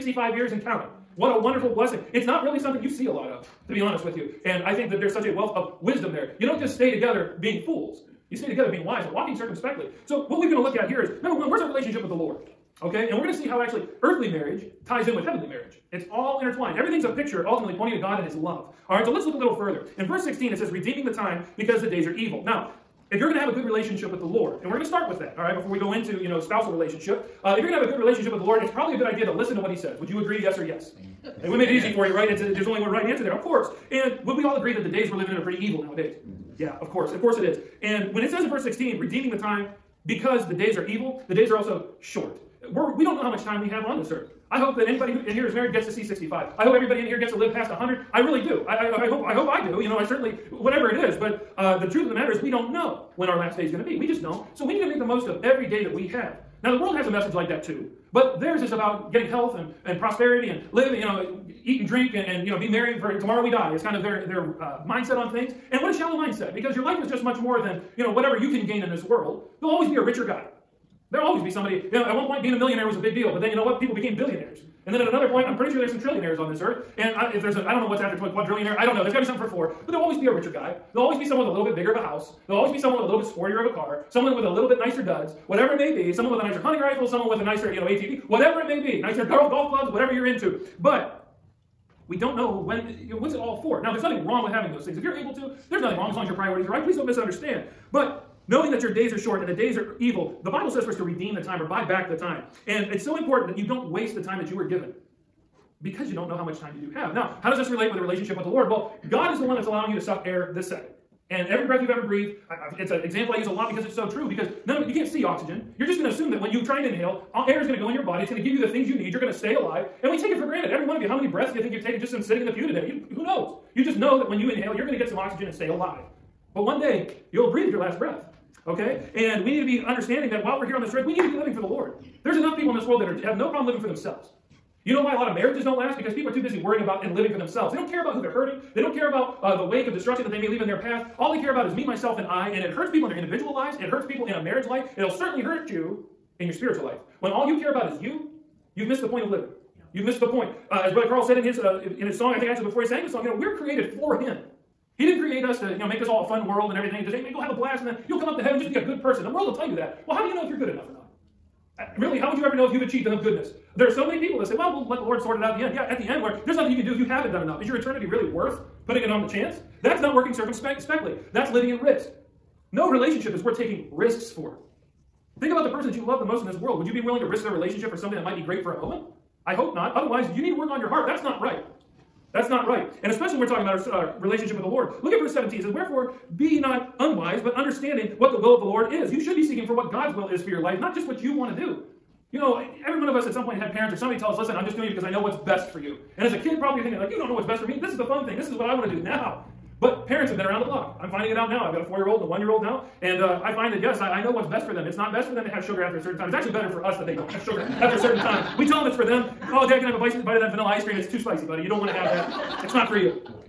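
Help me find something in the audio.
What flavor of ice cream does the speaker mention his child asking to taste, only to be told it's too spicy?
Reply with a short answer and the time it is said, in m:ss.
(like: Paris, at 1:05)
vanilla, at 3:30.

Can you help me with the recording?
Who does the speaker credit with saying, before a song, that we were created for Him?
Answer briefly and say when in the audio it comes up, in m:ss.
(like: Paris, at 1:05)
Brother Carl, at 2:30.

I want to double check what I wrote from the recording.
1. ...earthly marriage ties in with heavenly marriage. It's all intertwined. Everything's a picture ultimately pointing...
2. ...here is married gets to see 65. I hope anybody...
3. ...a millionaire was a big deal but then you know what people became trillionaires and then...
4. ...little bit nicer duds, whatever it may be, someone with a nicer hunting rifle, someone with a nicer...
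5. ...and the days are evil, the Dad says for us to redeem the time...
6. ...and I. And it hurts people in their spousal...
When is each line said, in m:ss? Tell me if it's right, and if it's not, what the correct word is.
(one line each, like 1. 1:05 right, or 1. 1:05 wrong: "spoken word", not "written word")
1. 0:14 right
2. 0:45 wrong: "everybody", not "anybody"
3. 1:12 wrong: "billionaires", not "trillionaires"
4. 1:24 right
5. 1:39 wrong: "Bible", not "Dad"
6. 2:22 wrong: "individual", not "spousal".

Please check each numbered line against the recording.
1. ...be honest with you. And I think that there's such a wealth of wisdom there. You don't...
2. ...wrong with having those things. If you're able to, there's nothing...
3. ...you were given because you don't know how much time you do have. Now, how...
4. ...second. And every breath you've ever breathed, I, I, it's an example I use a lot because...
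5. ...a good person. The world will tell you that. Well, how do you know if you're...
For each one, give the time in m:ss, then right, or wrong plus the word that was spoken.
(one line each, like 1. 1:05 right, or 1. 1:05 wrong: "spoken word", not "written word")
1. 0:03 right
2. 1:34 right
3. 1:44 right
4. 1:50 right
5. 2:38 right.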